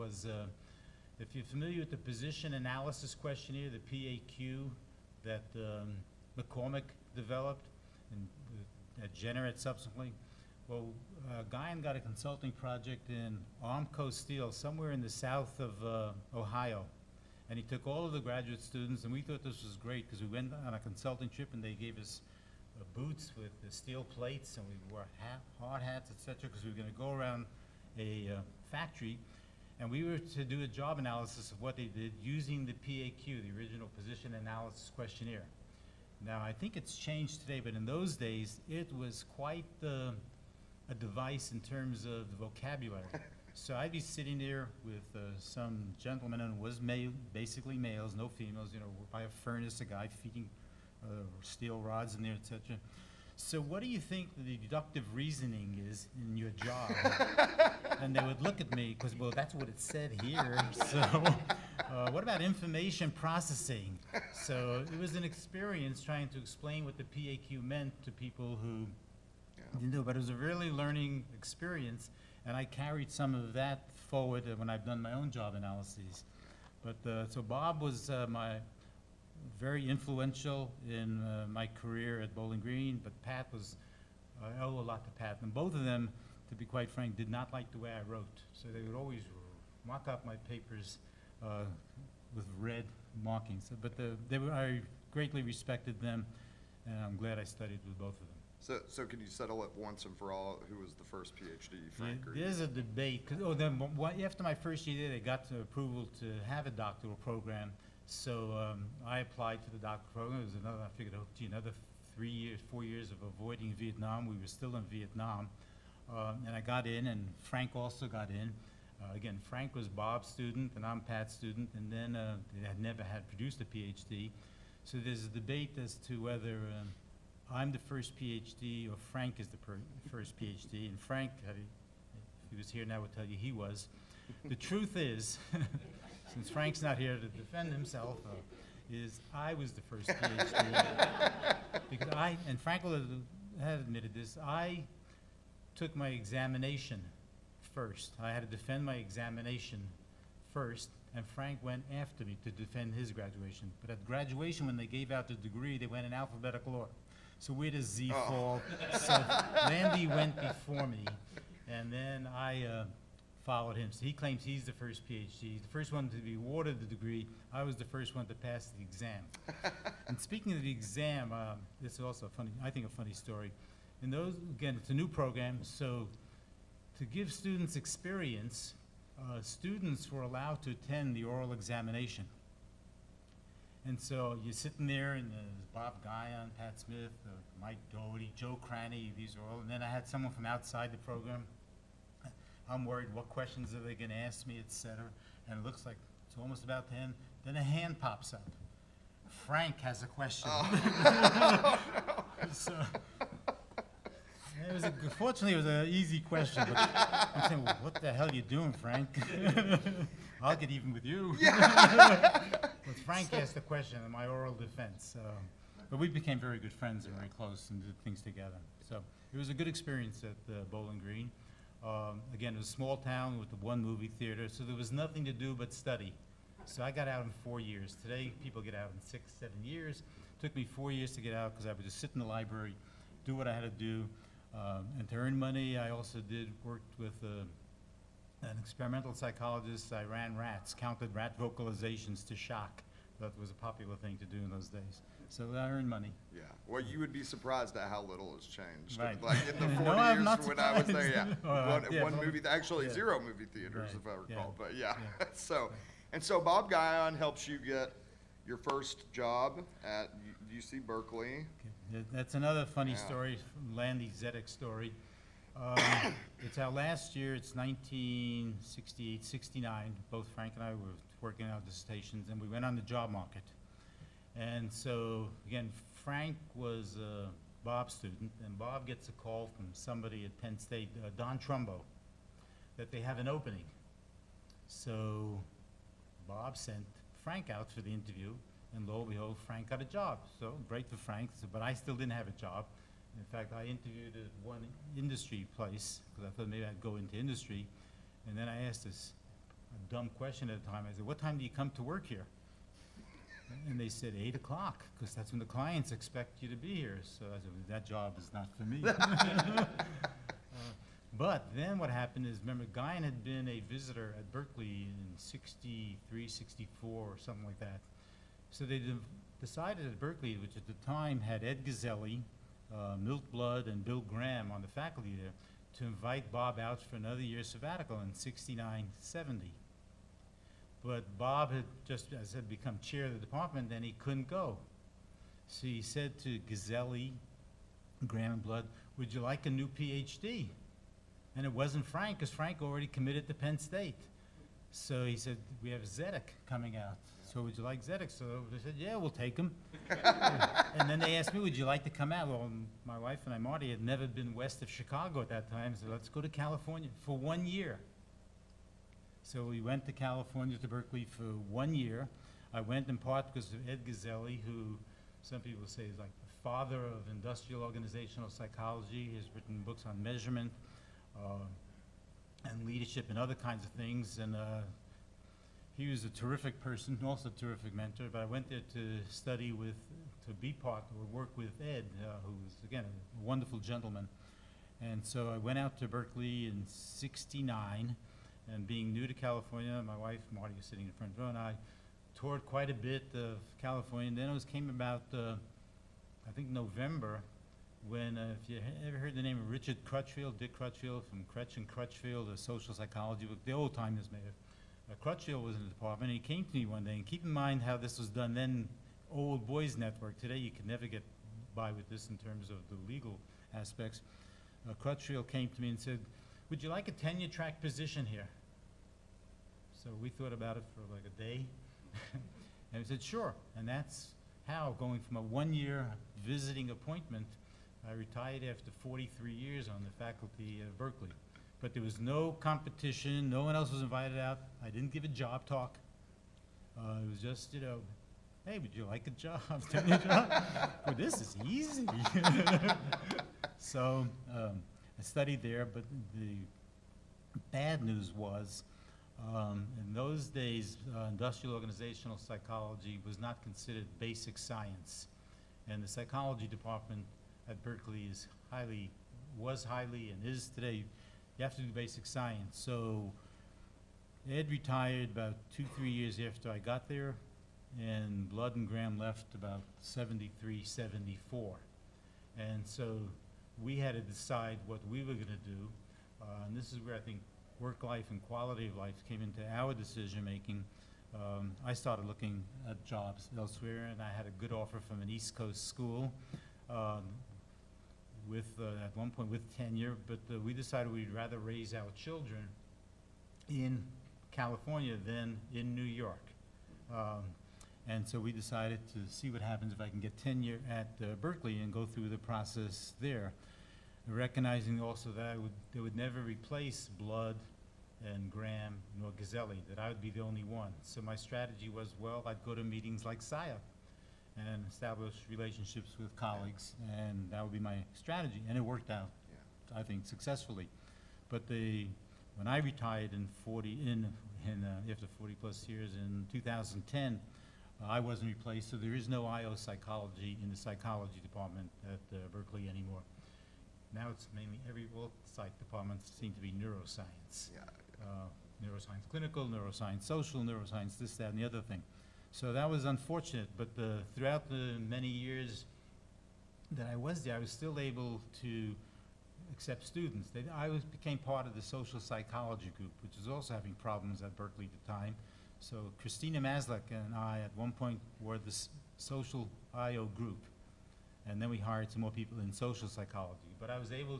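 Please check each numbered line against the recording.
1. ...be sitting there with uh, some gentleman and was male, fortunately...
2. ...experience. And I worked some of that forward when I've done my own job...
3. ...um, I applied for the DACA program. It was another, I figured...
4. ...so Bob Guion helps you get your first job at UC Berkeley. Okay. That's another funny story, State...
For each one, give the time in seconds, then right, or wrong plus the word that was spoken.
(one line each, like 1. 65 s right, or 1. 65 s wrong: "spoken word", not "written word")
1. 43 s wrong: "basically", not "fortunately"
2. 71 s wrong: "carried", not "worked"
3. 108 s right
4. 256 s wrong: "Landy", not "State".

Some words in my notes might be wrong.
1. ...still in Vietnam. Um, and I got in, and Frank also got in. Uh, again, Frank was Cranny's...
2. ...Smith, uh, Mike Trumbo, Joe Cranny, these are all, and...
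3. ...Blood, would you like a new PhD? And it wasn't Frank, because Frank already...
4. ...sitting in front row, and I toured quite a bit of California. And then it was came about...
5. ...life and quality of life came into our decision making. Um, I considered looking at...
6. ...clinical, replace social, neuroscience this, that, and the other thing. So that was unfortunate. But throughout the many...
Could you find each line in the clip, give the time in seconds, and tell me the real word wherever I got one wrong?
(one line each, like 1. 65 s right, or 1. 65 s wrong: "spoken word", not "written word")
1. 114 s wrong: "Bob", not "Cranny"
2. 186 s wrong: "Doherty", not "Trumbo"
3. 338 s right
4. 390 s right
5. 477 s wrong: "started", not "considered"
6. 539 s wrong: "neuroscience", not "replace".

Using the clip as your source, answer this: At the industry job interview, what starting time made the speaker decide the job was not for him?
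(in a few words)
8 o'clock.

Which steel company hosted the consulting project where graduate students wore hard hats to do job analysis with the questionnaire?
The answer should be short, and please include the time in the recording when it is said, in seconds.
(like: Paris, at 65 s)
Armco Steel, at 13 s.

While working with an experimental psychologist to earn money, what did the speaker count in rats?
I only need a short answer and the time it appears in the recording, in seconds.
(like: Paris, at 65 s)
Rat vocalizations, at 241 s.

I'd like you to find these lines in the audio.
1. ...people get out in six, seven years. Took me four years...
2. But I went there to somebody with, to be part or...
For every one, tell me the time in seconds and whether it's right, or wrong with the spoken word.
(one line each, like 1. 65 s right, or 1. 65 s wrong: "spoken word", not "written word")
1. 228 s right
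2. 378 s wrong: "study", not "somebody".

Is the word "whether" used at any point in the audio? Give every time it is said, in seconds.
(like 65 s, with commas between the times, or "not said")
126 s.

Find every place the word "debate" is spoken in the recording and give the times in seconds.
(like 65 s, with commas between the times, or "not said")
102 s, 125 s.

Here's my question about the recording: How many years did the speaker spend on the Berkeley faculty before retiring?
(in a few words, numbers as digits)
43.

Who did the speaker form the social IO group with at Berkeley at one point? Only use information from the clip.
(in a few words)
Christina Maslach.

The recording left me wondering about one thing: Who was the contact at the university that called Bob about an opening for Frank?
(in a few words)
Don Trumbo.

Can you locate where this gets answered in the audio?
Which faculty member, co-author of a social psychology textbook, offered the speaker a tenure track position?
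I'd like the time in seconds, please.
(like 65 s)
399 s.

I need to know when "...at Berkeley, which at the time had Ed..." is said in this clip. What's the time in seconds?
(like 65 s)
319 s.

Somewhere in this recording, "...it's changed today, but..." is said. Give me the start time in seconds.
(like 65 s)
36 s.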